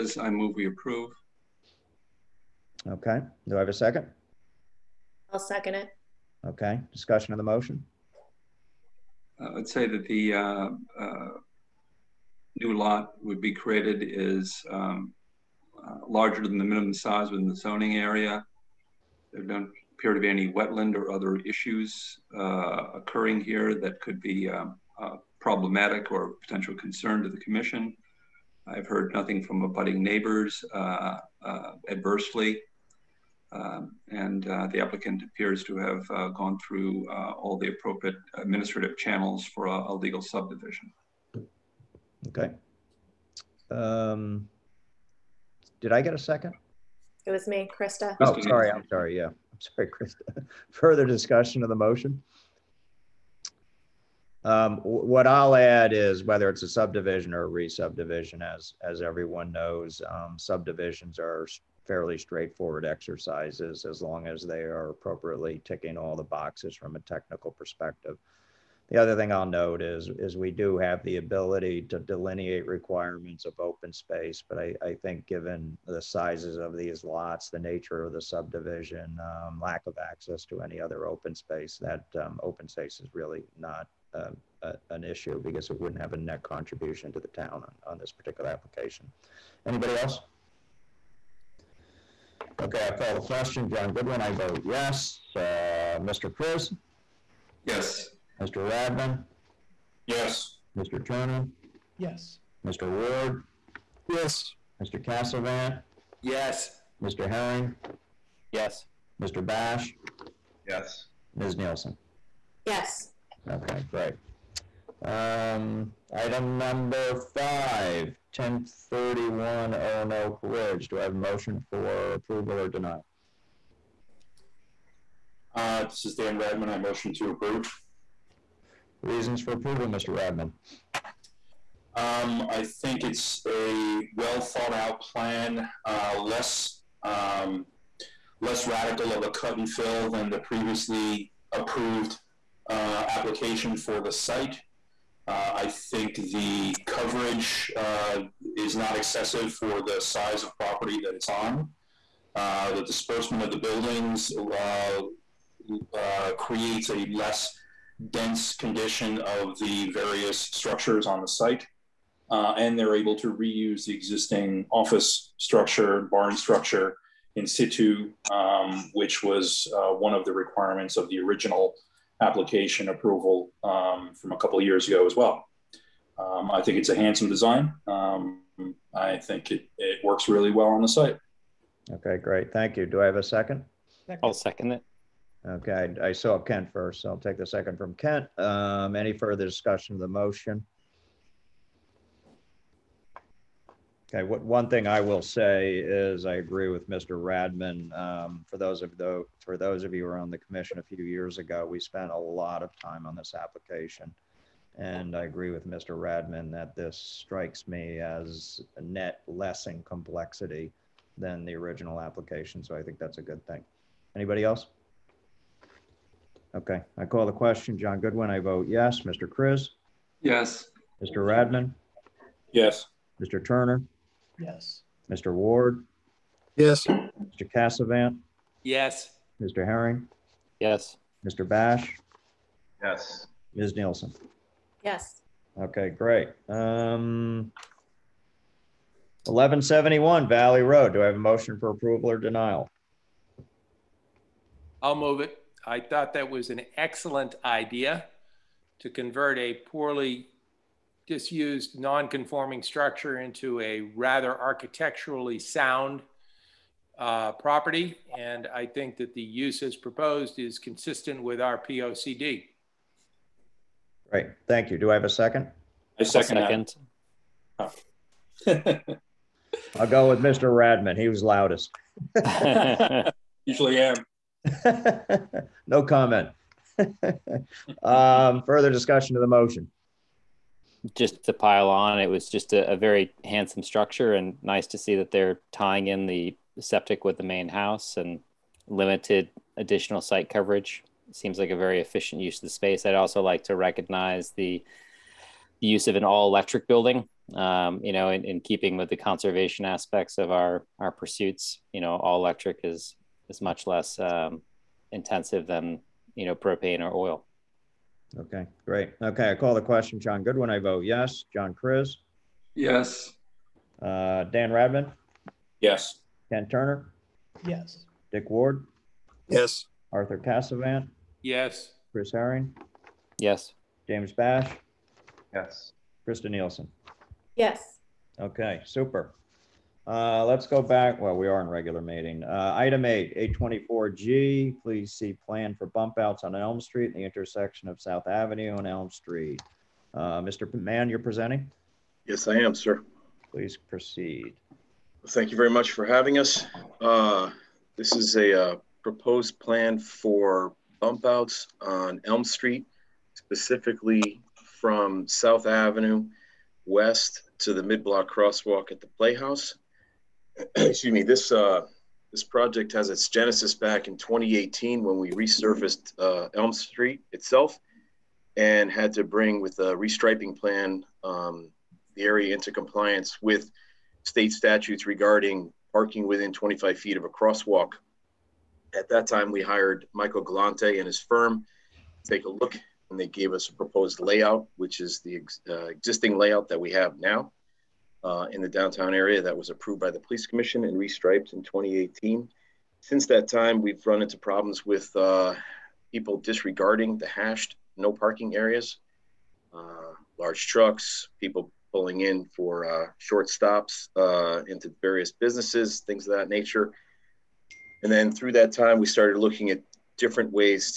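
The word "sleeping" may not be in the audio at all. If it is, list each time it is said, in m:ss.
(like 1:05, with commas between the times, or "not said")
not said.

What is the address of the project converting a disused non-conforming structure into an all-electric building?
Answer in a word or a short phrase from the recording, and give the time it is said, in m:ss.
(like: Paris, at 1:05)
1171 Valley Road, at 3:59.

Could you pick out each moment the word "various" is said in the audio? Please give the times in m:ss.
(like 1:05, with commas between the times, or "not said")
2:39, 6:44.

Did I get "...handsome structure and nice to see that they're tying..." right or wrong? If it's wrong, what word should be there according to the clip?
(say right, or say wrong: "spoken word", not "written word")
right.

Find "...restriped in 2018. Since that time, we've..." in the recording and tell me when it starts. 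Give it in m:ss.
6:30.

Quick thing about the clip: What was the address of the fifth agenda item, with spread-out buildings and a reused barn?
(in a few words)
1031 Oenoke Ridge.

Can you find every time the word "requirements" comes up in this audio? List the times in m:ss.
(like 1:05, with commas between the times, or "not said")
1:12, 2:50.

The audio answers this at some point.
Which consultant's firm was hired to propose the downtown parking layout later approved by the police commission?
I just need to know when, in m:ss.
6:19.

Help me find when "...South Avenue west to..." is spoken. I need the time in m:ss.
5:55.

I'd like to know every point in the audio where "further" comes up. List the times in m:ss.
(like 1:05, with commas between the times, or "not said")
0:50, 3:09, 4:38.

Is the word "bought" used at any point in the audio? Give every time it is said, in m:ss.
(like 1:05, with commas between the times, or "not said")
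not said.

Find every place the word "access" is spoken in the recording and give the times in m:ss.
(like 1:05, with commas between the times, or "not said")
1:19.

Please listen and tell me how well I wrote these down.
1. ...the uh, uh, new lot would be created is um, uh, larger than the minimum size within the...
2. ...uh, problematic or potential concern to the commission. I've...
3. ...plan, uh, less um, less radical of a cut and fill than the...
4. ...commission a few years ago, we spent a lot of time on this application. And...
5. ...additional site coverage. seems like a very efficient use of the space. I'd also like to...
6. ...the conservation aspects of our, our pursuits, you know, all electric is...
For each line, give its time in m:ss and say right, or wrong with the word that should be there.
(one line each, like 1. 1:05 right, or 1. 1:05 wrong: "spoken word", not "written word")
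1. 0:10 right
2. 0:24 right
3. 2:15 right
4. 3:20 right
5. 4:49 right
6. 4:58 right.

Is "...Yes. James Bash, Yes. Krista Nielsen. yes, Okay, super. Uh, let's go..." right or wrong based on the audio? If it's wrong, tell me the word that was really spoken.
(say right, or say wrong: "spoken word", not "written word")
right.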